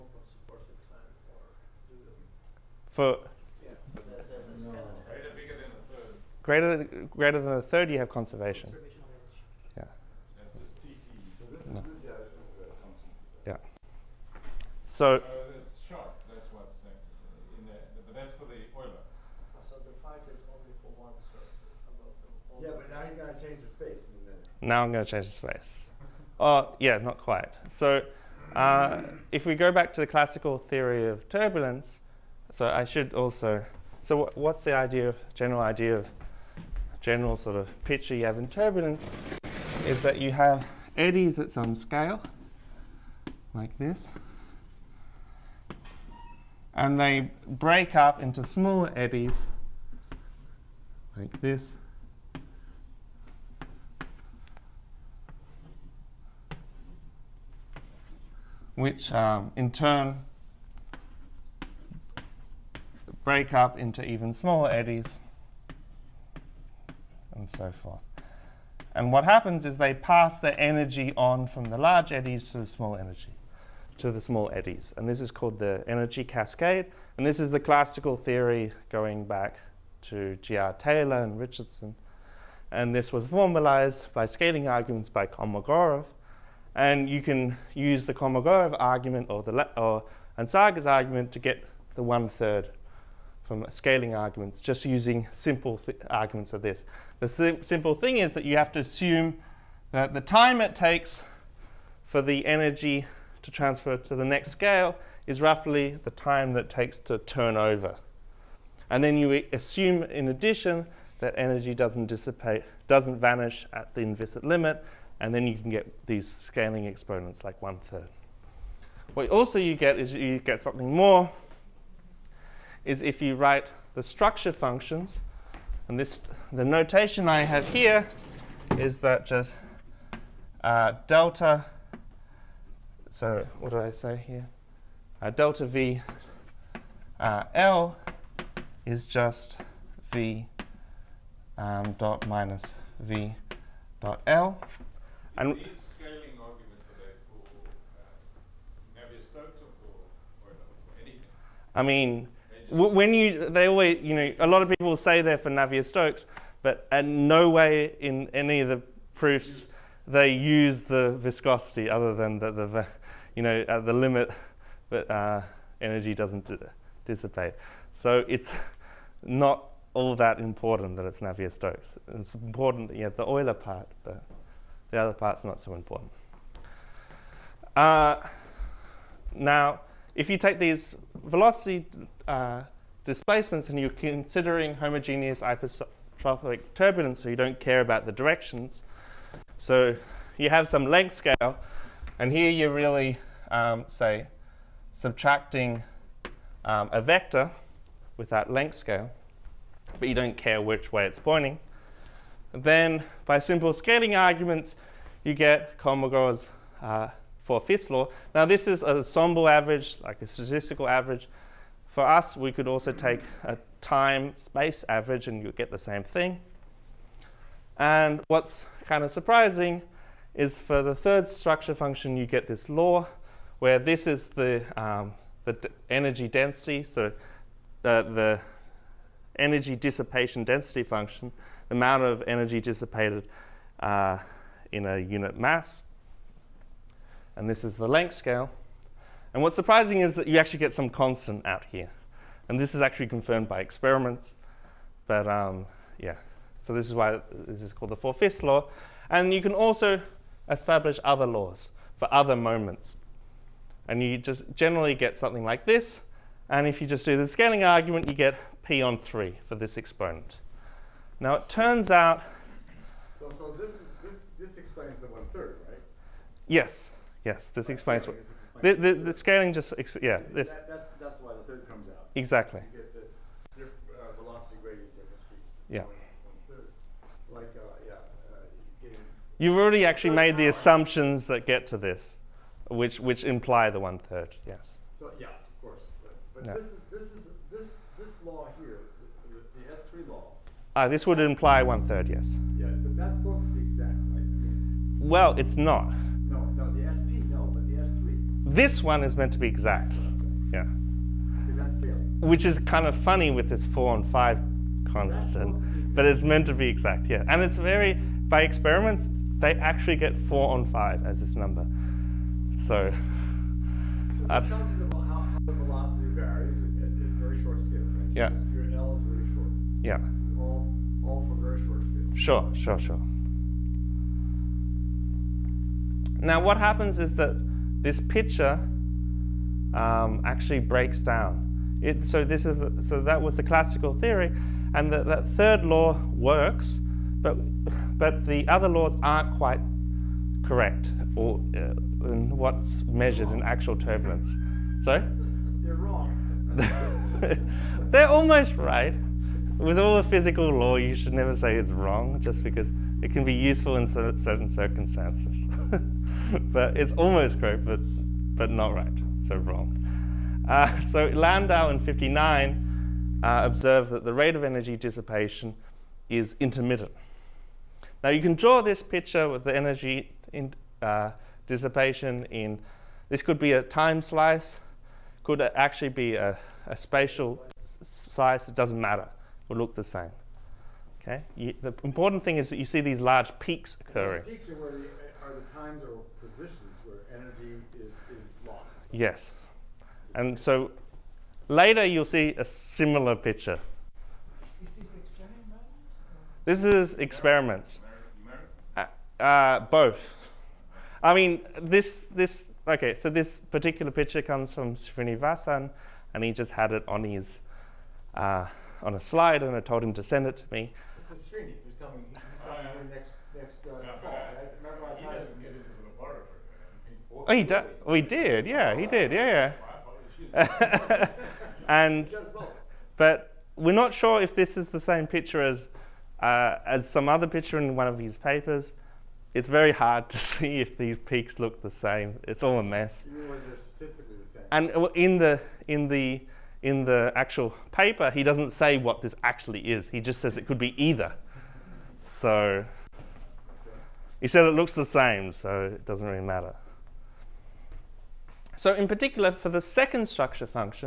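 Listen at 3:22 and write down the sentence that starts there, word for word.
And then by simple scaling arguments, you get Kolmogorov's uh, four-fifths law.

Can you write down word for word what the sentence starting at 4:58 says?
This one is meant to be exact.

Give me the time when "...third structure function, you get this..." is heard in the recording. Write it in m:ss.
3:40.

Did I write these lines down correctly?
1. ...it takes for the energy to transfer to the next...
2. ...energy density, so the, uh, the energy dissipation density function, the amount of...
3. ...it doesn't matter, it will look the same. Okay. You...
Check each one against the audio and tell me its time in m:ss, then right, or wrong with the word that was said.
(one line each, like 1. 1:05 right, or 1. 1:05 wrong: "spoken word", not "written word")
1. 1:40 right
2. 3:45 right
3. 6:18 right.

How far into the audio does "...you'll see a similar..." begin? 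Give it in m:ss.
6:31.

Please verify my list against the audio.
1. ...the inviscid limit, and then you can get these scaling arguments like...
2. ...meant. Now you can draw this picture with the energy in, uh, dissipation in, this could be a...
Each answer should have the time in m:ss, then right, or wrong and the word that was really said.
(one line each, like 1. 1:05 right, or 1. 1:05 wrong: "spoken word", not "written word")
1. 1:53 wrong: "exponents", not "arguments"
2. 6:06 wrong: "intermittent", not "meant".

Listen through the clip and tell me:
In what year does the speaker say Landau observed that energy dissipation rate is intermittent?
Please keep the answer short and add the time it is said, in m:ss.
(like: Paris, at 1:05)
1959, at 6:01.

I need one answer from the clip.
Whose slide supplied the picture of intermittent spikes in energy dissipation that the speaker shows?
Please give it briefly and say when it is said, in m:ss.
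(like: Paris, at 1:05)
Srinivasan, at 6:44.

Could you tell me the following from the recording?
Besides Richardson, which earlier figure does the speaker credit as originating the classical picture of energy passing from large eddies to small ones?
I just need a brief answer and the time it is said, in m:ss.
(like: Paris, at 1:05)
G.R. Taylor, at 1:20.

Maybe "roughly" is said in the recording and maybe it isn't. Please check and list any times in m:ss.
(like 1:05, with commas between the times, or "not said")
1:45.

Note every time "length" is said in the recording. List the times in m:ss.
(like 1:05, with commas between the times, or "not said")
3:10, 3:18, 3:57.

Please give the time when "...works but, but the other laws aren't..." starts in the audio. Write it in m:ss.
5:36.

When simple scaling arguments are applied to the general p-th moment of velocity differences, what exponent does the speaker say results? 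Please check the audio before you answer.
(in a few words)
p on 3.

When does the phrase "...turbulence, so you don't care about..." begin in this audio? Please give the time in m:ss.
3:06.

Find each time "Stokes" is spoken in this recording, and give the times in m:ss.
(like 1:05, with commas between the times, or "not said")
2:35, 2:51.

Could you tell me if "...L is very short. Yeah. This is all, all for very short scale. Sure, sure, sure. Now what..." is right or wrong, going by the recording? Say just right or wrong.
right.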